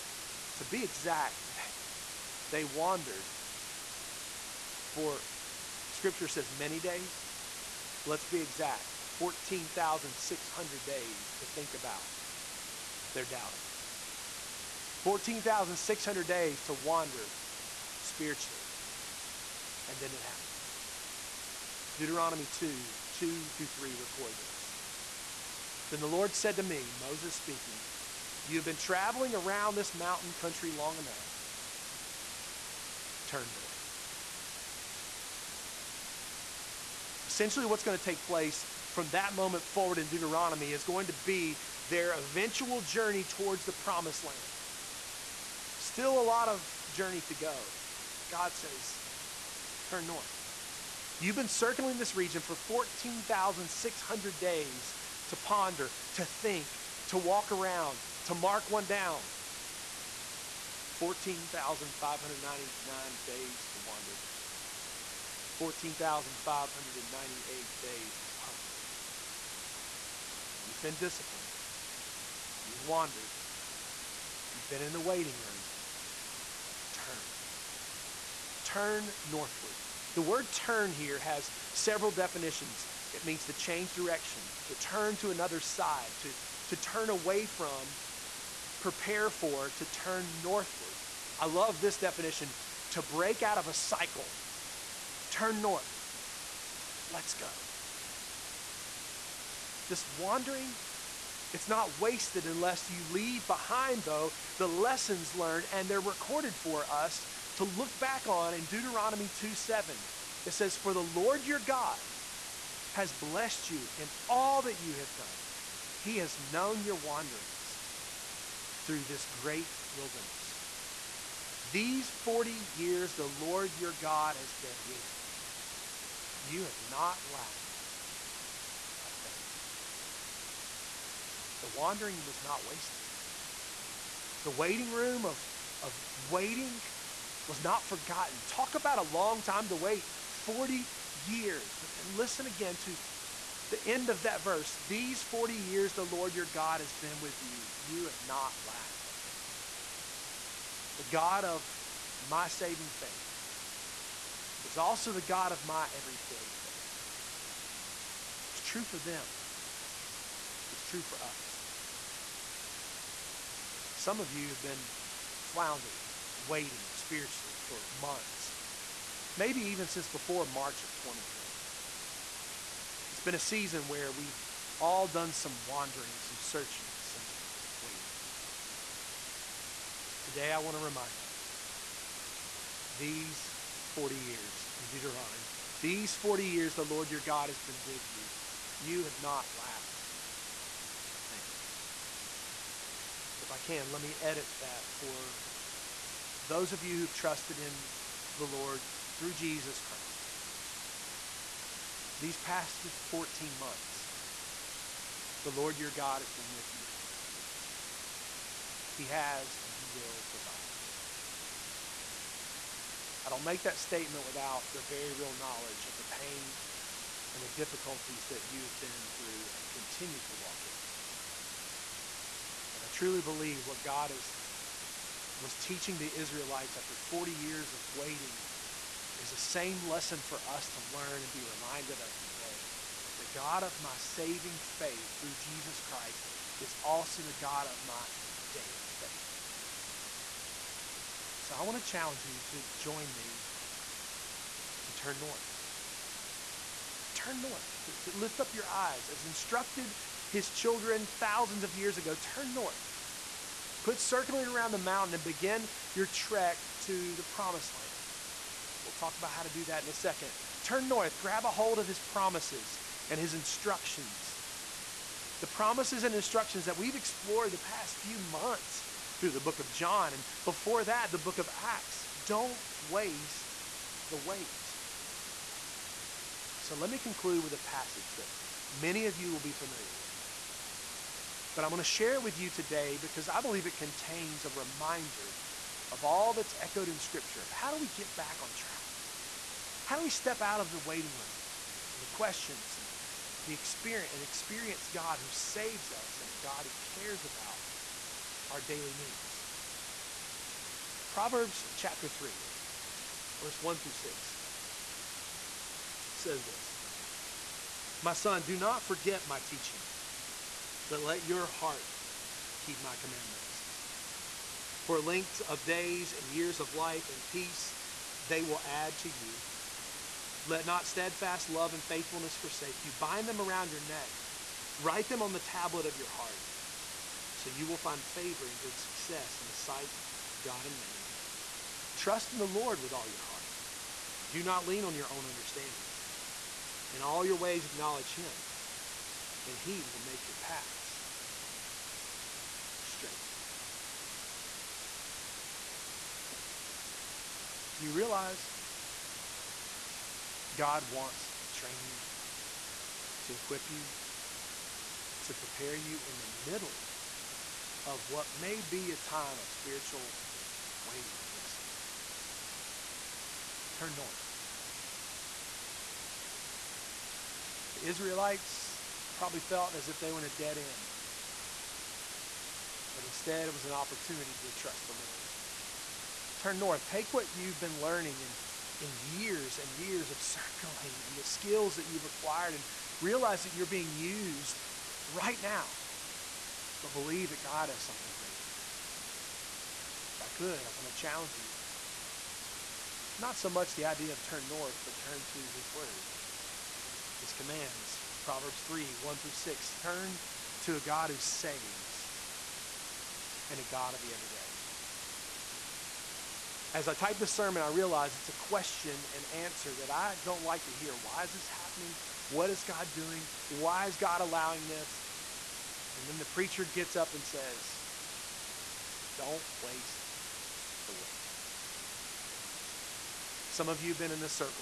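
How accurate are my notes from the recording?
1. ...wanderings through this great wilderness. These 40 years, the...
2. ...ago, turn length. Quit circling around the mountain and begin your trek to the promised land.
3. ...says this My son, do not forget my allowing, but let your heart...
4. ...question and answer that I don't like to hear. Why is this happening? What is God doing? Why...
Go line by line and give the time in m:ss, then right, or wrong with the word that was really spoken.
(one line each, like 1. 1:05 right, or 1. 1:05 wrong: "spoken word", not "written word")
1. 1:56 right
2. 4:11 wrong: "north", not "length"
3. 5:06 wrong: "teaching", not "allowing"
4. 6:48 right.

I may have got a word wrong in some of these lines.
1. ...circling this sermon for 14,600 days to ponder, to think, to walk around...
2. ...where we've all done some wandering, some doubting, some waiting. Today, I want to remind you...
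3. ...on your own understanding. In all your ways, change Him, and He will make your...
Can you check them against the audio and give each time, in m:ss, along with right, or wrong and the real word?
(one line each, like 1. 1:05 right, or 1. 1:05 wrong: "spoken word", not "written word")
1. 0:51 wrong: "region", not "sermon"
2. 2:53 wrong: "searching", not "doubting"
3. 5:34 wrong: "acknowledge", not "change".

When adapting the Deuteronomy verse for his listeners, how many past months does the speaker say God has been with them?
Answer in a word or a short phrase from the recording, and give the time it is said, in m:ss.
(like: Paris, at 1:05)
14, at 3:23.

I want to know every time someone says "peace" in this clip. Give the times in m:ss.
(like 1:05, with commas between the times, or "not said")
5:17.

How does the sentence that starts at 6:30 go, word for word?
If I could, I want to challenge you.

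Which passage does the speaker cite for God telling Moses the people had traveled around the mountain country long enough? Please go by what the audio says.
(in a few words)
Deuteronomy 2:2-3.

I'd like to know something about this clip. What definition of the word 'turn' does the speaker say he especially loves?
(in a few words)
To break out of a cycle.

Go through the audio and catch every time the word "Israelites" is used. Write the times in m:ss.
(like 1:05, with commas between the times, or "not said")
3:46, 6:07.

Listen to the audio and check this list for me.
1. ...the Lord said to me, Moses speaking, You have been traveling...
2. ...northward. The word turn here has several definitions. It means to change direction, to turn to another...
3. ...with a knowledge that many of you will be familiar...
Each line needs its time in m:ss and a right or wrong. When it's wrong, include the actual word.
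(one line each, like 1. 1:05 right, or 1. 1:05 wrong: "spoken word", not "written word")
1. 0:25 right
2. 1:19 right
3. 4:37 wrong: "passage", not "knowledge".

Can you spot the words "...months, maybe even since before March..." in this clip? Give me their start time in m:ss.
2:47.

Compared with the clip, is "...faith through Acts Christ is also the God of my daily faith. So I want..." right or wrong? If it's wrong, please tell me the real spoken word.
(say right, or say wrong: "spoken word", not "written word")
wrong: "Jesus", not "Acts".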